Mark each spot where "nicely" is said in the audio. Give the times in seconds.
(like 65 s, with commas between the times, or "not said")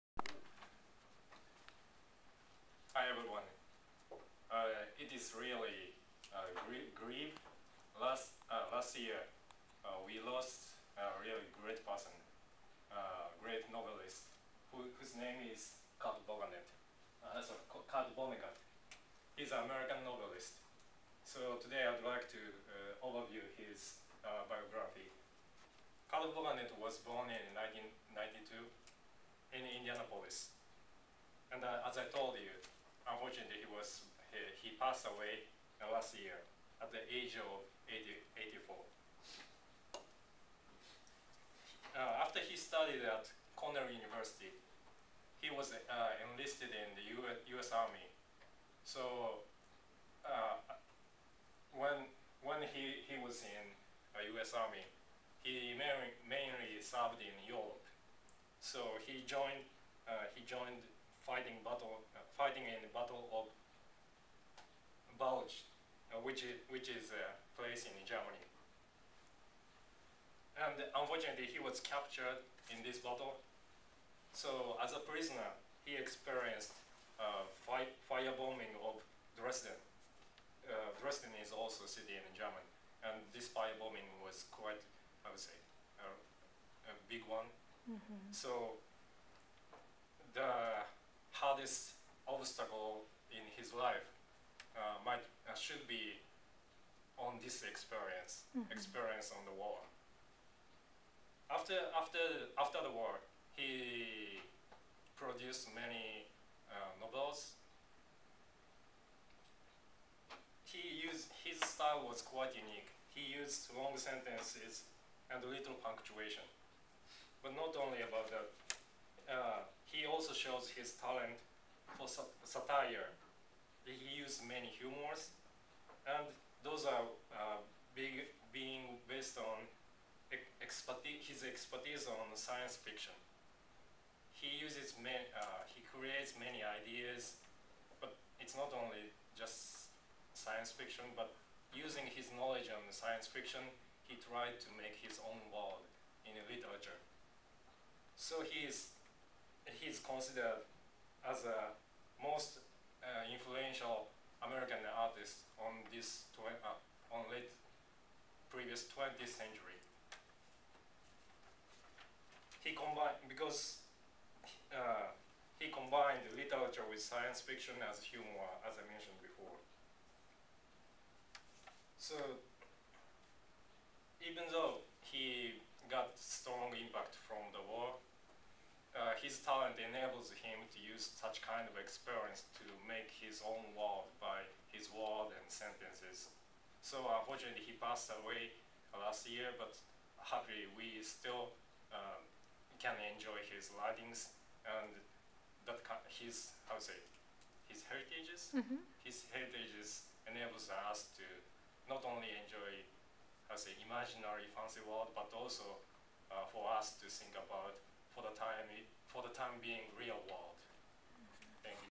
not said.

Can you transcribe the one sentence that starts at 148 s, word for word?
So he is, he is considered as a most American artists on this uh, on late previous 20th century.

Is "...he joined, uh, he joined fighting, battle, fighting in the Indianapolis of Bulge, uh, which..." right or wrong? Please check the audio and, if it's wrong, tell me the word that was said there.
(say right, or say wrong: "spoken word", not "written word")
wrong: "Battle", not "Indianapolis".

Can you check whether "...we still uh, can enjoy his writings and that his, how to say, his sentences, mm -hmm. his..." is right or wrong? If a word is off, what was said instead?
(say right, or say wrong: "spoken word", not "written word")
wrong: "heritages", not "sentences".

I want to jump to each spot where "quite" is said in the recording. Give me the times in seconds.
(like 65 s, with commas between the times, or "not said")
84 s, 112 s.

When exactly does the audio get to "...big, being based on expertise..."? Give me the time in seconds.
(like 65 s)
127 s.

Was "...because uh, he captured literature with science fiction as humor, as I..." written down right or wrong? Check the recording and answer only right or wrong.
wrong.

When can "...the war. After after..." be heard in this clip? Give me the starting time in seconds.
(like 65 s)
99 s.